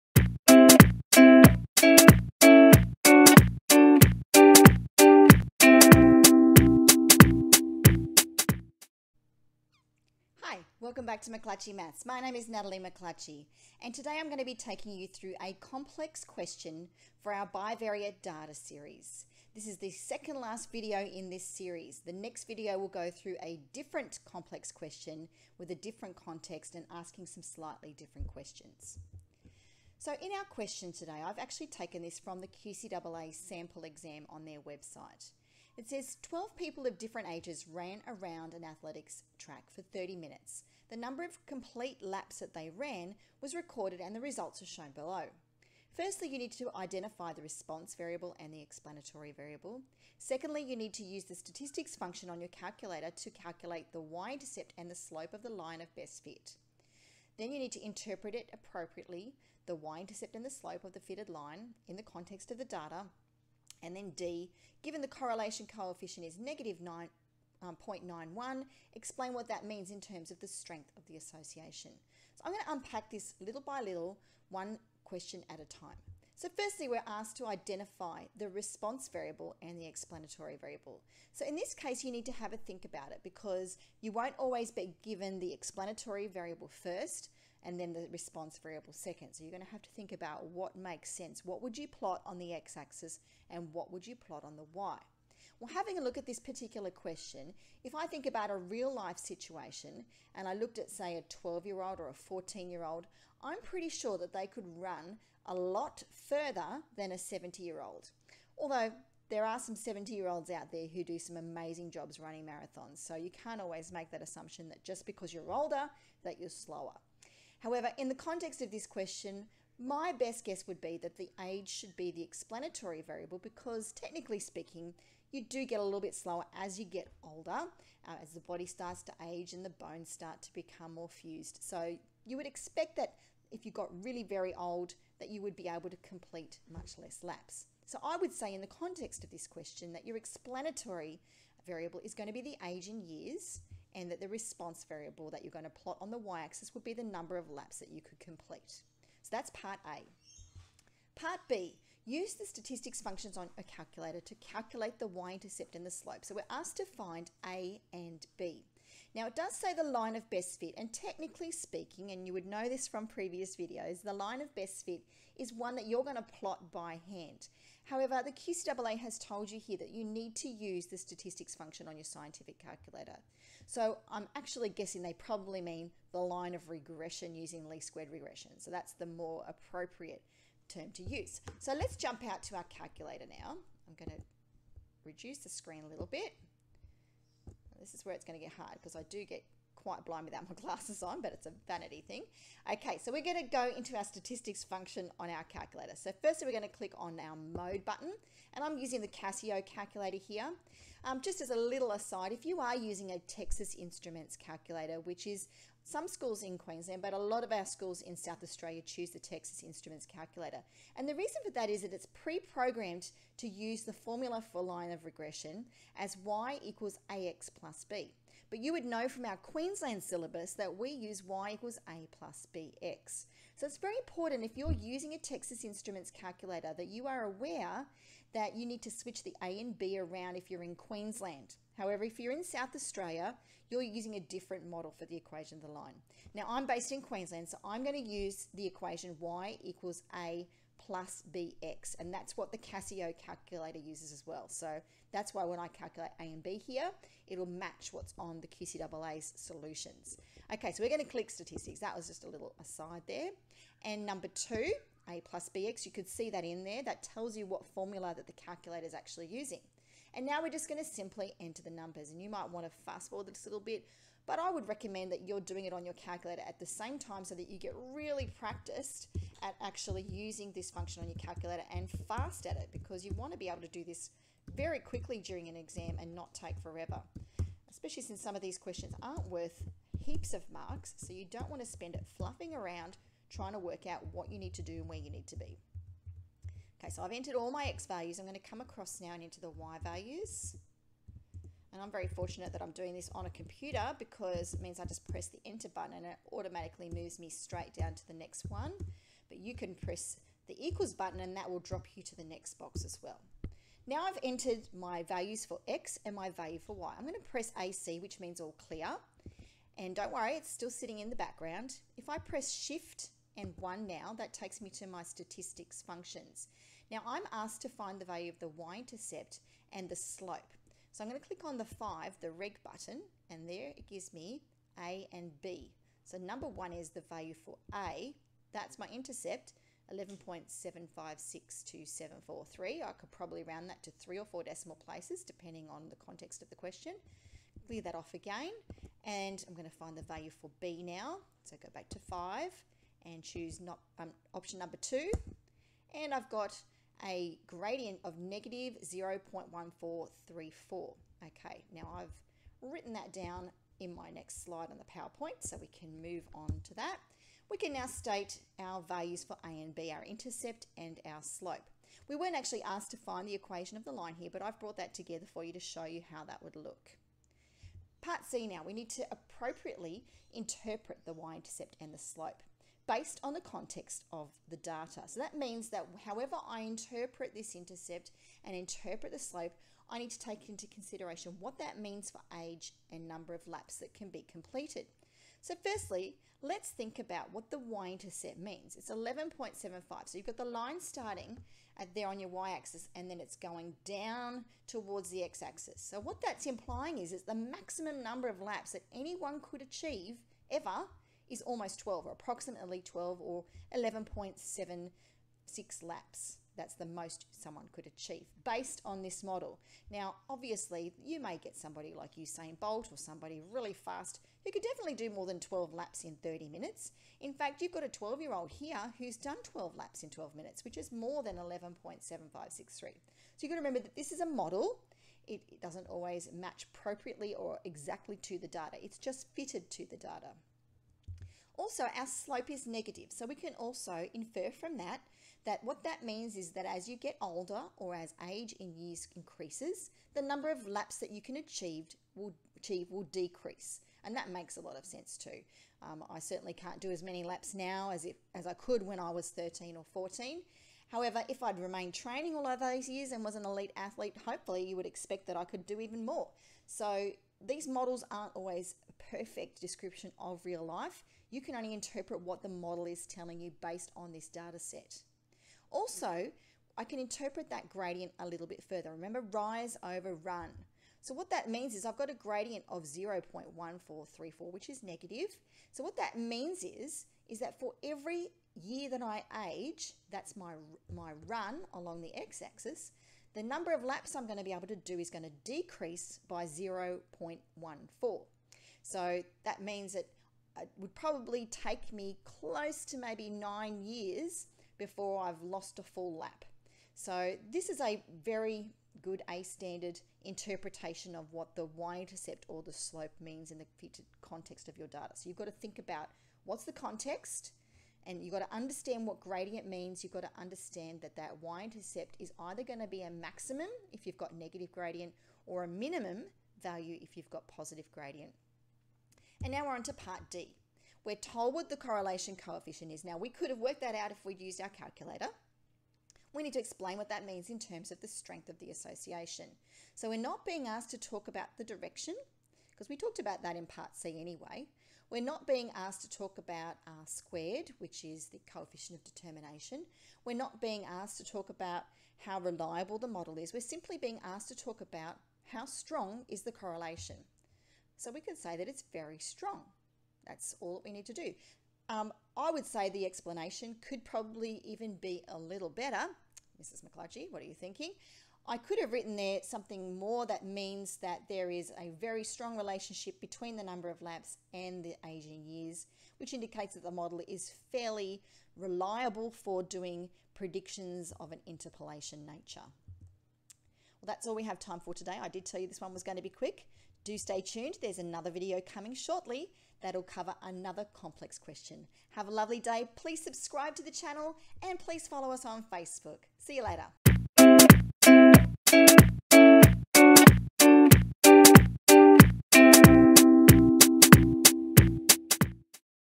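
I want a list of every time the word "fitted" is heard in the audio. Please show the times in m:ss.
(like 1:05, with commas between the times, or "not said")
1:00, 7:09.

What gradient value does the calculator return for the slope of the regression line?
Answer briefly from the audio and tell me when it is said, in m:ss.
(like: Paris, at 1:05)
-0.1434, at 5:48.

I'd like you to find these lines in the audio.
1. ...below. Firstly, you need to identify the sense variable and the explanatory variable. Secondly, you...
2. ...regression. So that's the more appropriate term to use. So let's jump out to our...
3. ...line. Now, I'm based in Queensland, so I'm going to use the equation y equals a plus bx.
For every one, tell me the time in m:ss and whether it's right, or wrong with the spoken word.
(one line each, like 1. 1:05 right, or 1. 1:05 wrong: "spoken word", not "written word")
1. 0:44 wrong: "response", not "sense"
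2. 2:58 right
3. 3:55 right.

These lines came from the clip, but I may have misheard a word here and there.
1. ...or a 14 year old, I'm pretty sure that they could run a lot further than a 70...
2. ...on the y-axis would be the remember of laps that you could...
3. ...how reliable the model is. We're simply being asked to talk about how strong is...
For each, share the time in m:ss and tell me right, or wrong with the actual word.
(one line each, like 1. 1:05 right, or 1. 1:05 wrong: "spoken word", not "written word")
1. 1:41 right
2. 2:26 wrong: "number", not "remember"
3. 9:02 right.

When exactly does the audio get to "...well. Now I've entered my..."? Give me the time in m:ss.
5:03.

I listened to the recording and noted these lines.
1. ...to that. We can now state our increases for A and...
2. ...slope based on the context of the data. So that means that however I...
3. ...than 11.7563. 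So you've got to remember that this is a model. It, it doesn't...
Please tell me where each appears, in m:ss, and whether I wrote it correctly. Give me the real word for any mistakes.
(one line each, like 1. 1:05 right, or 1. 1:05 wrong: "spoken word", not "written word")
1. 5:56 wrong: "values", not "increases"
2. 6:11 right
3. 7:01 right.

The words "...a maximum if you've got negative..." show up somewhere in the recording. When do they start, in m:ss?
8:33.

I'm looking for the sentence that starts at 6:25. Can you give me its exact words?
So firstly, let's think about what the y-intercept means.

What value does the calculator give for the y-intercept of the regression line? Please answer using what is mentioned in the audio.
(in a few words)
11.7562743.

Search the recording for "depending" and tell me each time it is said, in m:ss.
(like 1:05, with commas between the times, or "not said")
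5:35.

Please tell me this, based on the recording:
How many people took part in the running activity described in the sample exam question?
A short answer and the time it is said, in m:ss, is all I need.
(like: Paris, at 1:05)
12, at 0:36.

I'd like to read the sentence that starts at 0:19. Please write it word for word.
This is the second last video in this series.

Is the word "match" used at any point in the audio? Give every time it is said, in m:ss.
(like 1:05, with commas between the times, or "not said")
4:07, 7:06.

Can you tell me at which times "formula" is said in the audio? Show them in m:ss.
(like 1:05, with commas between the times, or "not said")
3:33, 4:17.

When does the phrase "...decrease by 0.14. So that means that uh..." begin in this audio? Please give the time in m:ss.
8:05.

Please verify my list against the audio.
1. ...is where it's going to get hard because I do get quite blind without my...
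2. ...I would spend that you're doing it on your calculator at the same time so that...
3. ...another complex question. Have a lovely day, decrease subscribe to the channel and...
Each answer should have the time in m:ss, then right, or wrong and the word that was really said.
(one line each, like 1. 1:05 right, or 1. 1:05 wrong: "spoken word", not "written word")
1. 3:07 right
2. 4:24 wrong: "recommend", not "spend"
3. 9:40 wrong: "please", not "decrease".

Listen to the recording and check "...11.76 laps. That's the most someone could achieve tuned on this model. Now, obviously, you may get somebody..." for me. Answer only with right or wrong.
wrong.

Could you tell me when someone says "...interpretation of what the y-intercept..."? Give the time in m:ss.
8:20.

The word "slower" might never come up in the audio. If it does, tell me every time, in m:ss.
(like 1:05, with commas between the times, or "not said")
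1:56, 2:06.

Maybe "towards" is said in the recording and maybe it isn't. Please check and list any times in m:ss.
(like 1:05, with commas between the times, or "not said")
6:34.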